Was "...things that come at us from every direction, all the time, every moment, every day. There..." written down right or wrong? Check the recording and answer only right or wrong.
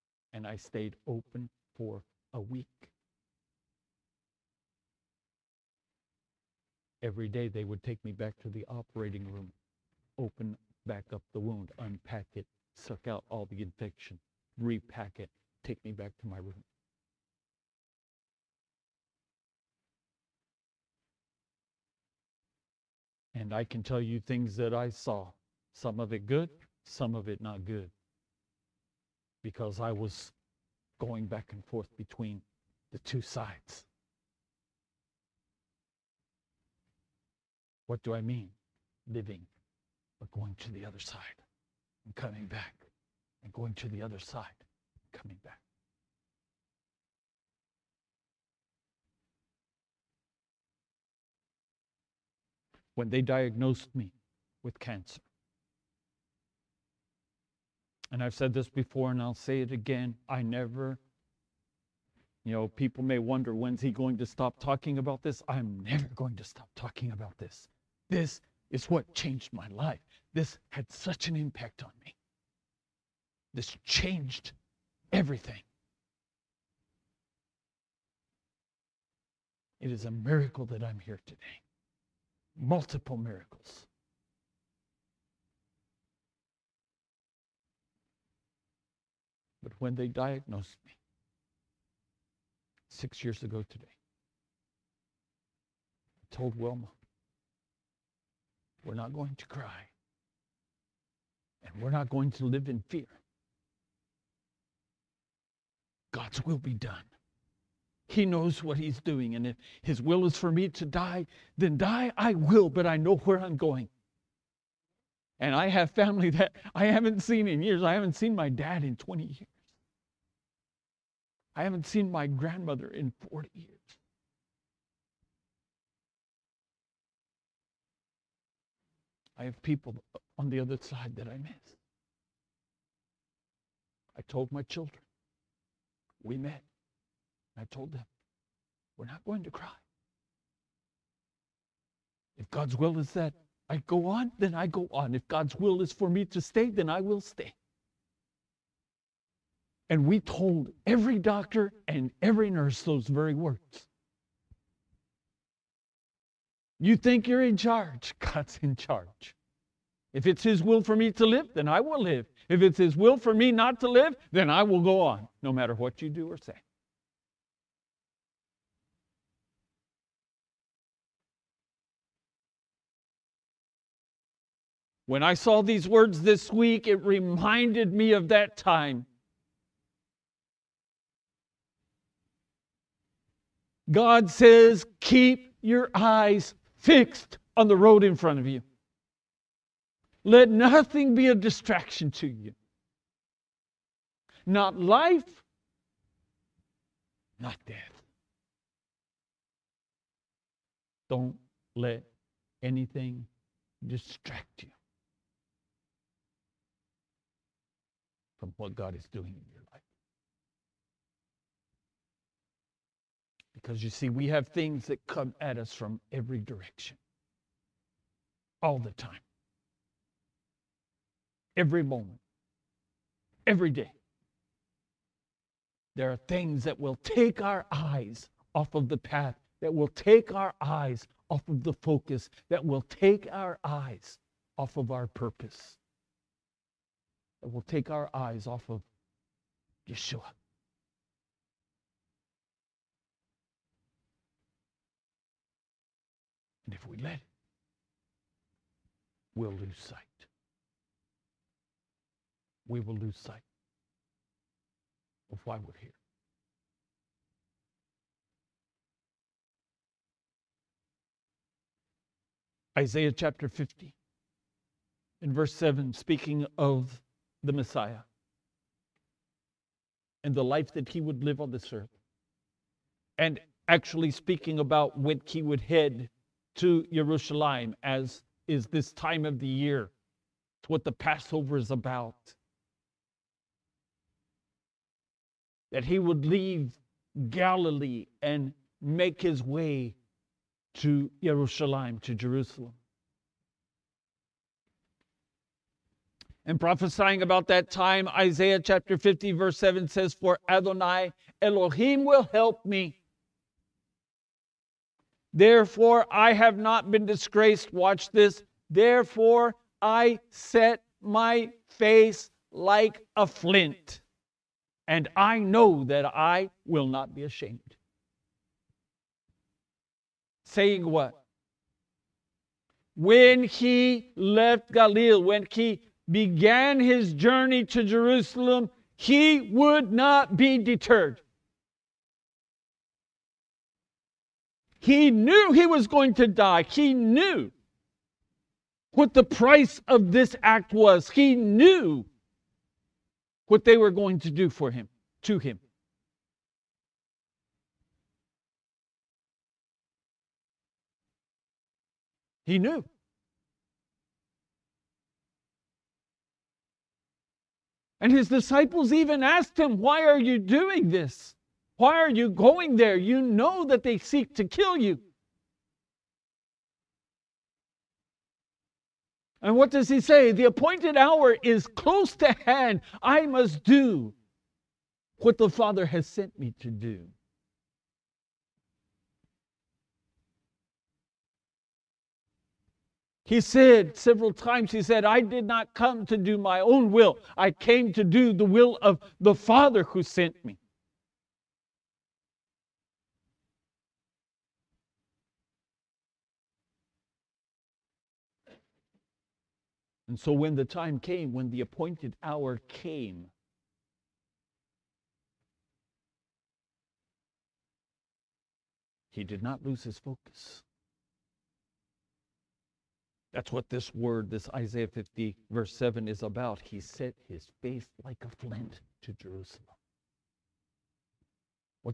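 right.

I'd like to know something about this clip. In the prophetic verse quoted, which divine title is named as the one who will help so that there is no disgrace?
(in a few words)
Adonai Elohim.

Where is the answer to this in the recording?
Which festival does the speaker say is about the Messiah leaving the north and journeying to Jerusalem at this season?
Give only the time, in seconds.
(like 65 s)
280 s.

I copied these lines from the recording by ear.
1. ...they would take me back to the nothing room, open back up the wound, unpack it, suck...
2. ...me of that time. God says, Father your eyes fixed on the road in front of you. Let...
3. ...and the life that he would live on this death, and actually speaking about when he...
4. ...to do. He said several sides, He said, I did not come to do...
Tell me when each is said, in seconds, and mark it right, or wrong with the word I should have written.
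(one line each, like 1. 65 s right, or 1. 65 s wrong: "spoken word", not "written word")
1. 7 s wrong: "operating", not "nothing"
2. 177 s wrong: "Keep", not "Father"
3. 270 s wrong: "earth", not "death"
4. 376 s wrong: "times", not "sides".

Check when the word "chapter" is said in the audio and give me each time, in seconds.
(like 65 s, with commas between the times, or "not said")
263 s, 298 s.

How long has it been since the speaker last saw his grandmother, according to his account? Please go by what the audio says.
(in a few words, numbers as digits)
40 years.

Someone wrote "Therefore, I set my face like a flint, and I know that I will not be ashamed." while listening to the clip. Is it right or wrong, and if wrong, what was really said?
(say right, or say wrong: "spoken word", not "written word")
right.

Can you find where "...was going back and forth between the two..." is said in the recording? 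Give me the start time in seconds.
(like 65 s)
29 s.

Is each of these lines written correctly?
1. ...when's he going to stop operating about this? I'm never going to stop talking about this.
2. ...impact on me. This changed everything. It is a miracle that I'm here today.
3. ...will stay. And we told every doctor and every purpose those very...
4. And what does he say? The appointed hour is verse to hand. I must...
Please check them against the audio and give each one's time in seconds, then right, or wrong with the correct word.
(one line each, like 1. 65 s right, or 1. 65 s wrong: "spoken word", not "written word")
1. 63 s wrong: "talking", not "operating"
2. 71 s right
3. 147 s wrong: "nurse", not "purpose"
4. 369 s wrong: "close", not "verse".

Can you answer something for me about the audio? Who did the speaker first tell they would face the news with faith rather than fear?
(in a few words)
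Wilma.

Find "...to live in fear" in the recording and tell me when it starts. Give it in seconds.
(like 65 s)
102 s.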